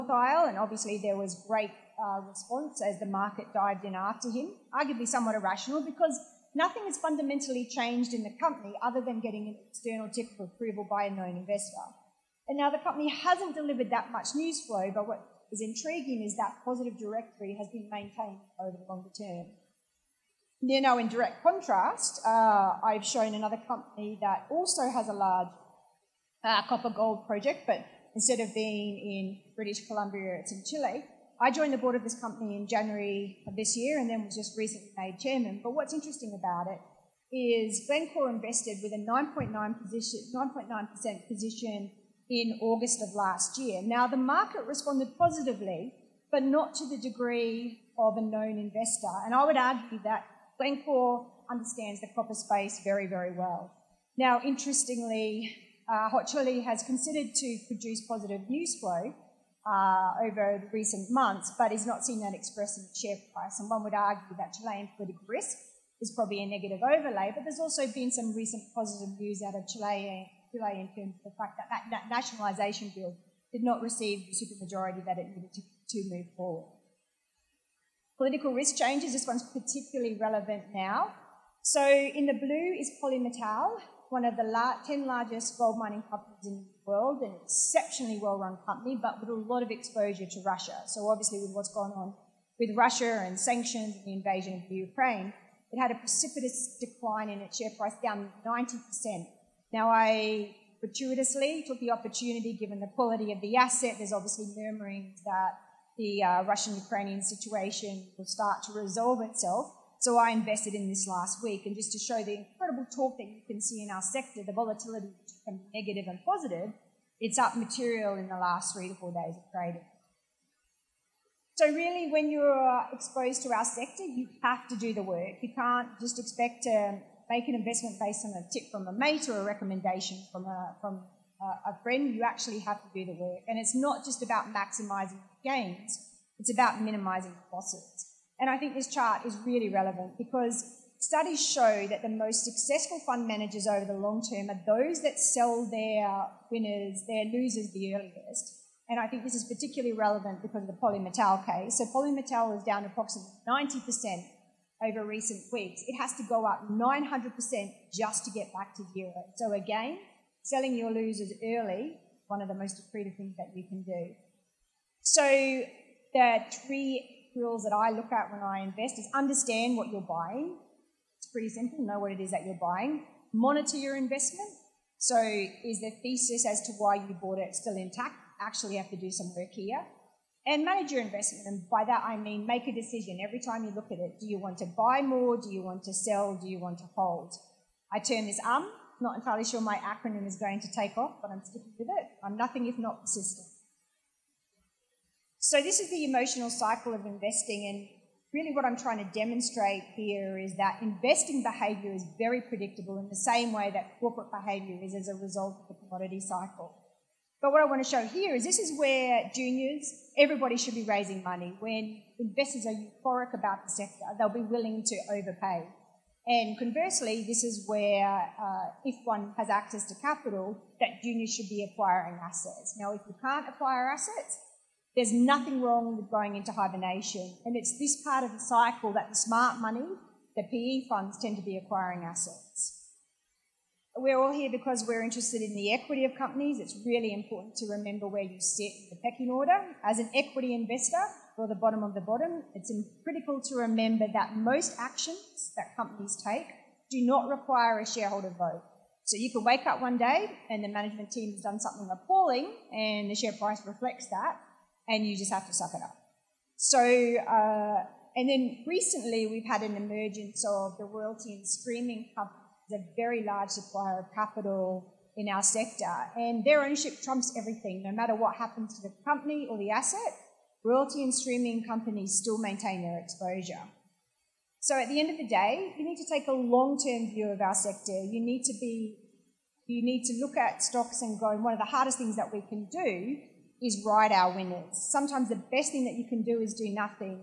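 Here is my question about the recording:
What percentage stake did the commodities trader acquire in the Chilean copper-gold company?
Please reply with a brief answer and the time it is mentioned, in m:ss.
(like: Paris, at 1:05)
9.9%, at 0:39.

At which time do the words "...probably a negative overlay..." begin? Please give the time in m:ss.
1:06.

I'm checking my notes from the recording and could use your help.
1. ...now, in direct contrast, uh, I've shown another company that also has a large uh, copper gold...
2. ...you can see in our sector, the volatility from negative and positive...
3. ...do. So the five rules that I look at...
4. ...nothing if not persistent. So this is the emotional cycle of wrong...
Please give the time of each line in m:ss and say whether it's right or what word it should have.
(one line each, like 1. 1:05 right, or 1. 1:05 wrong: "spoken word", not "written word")
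1. 0:20 right
2. 1:53 right
3. 2:43 wrong: "three", not "five"
4. 3:12 wrong: "investing", not "wrong".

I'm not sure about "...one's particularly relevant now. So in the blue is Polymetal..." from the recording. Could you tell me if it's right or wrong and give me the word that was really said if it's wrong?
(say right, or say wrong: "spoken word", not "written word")
right.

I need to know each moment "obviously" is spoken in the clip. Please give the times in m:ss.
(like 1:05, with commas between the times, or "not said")
0:00, 1:31, 1:44.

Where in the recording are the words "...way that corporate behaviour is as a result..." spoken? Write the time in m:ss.
3:23.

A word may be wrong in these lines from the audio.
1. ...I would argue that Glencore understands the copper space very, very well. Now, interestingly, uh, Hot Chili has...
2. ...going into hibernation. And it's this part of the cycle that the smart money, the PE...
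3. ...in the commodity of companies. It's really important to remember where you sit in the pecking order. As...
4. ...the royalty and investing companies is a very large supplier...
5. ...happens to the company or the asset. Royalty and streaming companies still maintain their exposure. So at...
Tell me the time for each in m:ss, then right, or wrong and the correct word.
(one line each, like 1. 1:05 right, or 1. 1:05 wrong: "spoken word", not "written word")
1. 0:49 right
2. 3:46 right
3. 3:55 wrong: "equity", not "commodity"
4. 4:20 wrong: "streaming", not "investing"
5. 4:28 right.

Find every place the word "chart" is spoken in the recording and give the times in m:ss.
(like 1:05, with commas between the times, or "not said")
2:18.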